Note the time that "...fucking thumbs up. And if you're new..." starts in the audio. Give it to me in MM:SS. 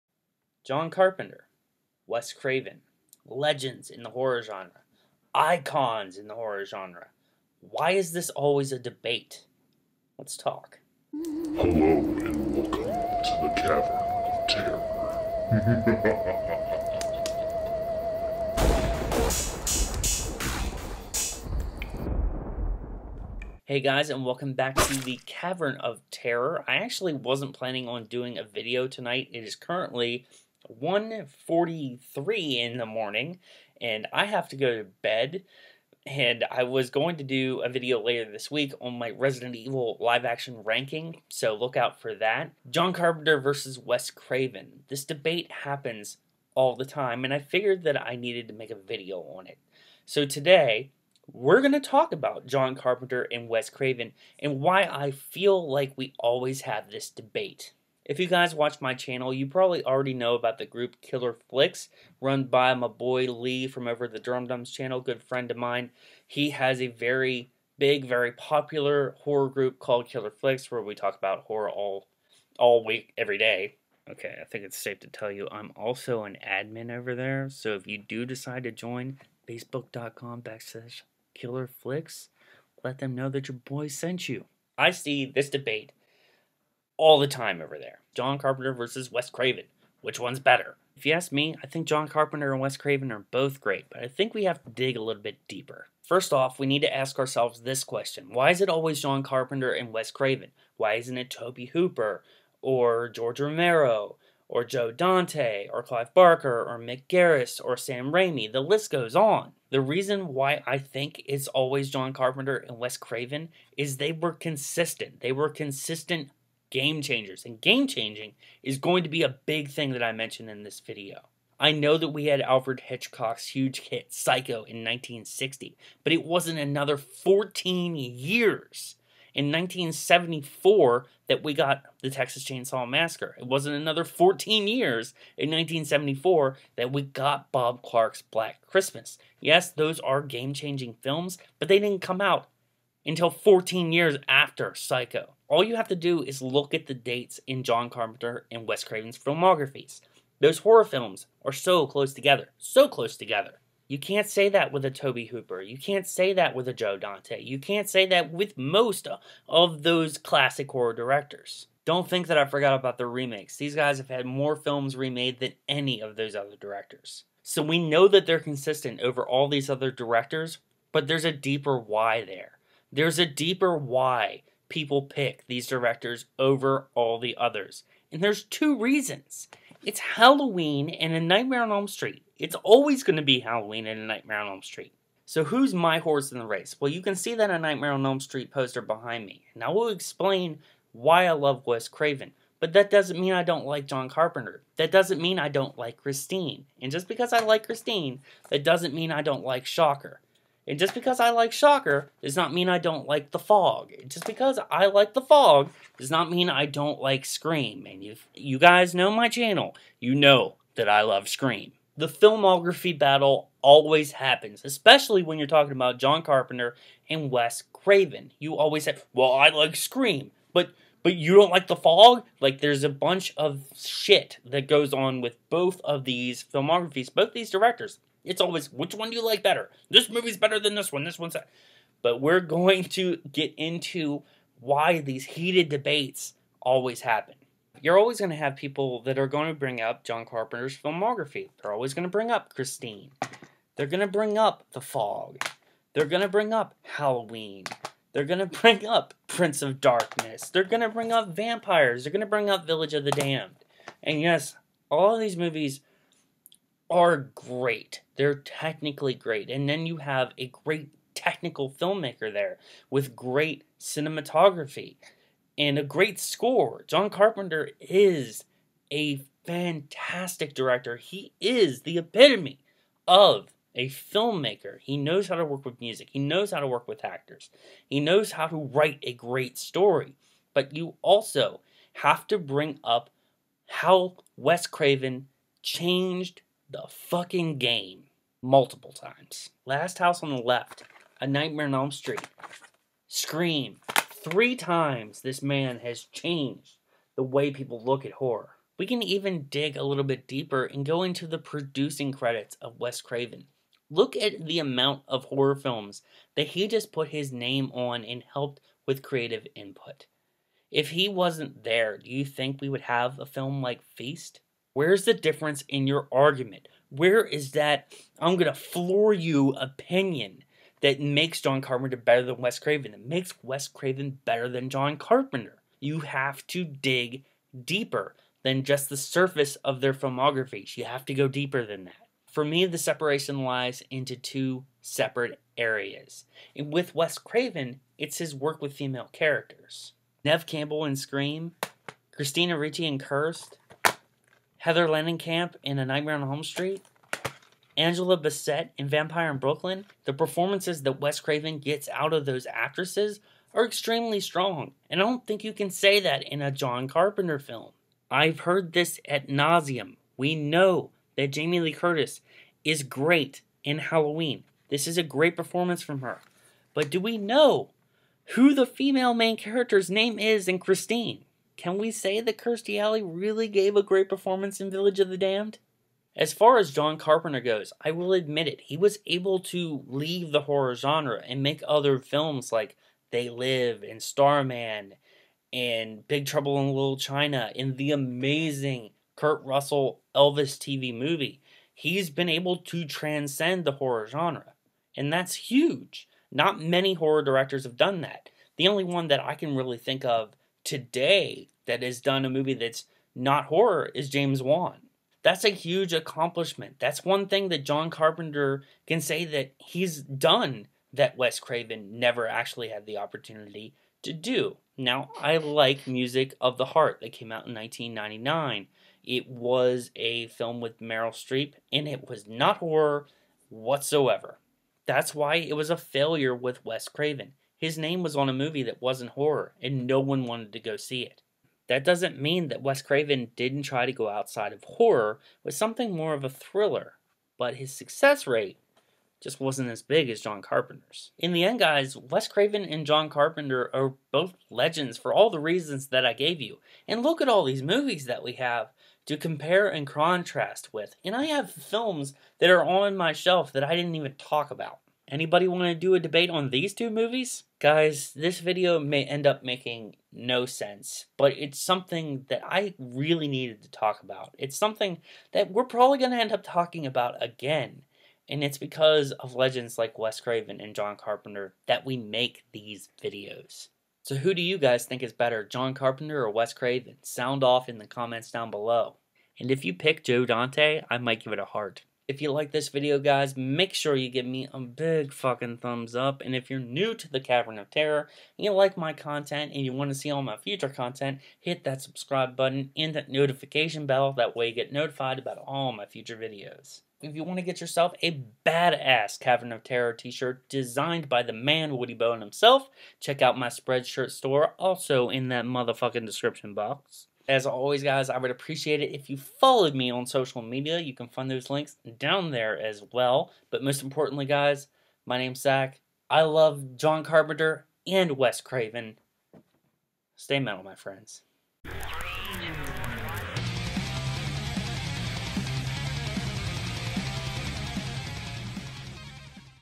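08:05.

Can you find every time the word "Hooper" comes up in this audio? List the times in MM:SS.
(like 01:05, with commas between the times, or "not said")
01:41, 02:35.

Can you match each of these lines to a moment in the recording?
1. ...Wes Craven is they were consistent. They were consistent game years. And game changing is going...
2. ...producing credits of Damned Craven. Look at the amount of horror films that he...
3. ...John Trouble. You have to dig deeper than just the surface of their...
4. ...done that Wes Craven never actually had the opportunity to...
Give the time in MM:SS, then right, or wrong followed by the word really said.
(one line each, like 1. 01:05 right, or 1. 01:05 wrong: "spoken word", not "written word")
1. 01:52 wrong: "changers", not "years"
2. 05:01 wrong: "Wes", not "Damned"
3. 05:24 wrong: "Carpenter", not "Trouble"
4. 06:50 right.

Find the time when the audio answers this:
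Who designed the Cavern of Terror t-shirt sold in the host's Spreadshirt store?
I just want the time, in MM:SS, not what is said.
08:21.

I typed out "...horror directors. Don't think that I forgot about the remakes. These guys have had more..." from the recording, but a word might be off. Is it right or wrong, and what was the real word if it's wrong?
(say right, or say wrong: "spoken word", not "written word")
right.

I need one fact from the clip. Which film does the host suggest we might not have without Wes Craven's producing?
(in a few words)
Feast.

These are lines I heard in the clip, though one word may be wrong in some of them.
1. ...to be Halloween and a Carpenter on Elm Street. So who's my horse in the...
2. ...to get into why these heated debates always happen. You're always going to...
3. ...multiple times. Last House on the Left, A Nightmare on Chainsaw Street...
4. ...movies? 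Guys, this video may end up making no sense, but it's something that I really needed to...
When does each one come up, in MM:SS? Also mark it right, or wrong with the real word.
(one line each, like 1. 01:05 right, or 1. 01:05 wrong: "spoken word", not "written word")
1. 03:03 wrong: "Nightmare", not "Carpenter"
2. 03:52 right
3. 04:48 wrong: "Elm", not "Chainsaw"
4. 07:36 right.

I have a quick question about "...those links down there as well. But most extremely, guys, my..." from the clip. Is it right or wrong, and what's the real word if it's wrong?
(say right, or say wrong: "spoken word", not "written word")
wrong: "importantly", not "extremely".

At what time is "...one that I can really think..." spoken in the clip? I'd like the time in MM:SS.
06:38.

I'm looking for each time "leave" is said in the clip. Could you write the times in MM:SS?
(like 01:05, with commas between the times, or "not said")
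06:19.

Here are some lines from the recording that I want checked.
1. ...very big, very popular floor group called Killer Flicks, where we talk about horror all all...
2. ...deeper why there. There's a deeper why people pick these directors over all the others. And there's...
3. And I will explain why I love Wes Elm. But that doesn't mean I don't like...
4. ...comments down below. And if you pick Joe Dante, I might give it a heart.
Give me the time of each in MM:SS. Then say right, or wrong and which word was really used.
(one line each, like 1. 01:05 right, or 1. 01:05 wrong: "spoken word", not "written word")
1. 01:06 wrong: "horror", not "floor"
2. 02:51 right
3. 03:09 wrong: "Craven", not "Elm"
4. 07:57 right.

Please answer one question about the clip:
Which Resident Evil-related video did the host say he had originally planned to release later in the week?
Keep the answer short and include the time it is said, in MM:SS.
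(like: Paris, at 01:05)
Resident Evil live action ranking, at 00:39.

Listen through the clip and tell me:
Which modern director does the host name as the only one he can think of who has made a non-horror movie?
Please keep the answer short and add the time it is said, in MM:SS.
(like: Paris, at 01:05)
James Wan, at 06:44.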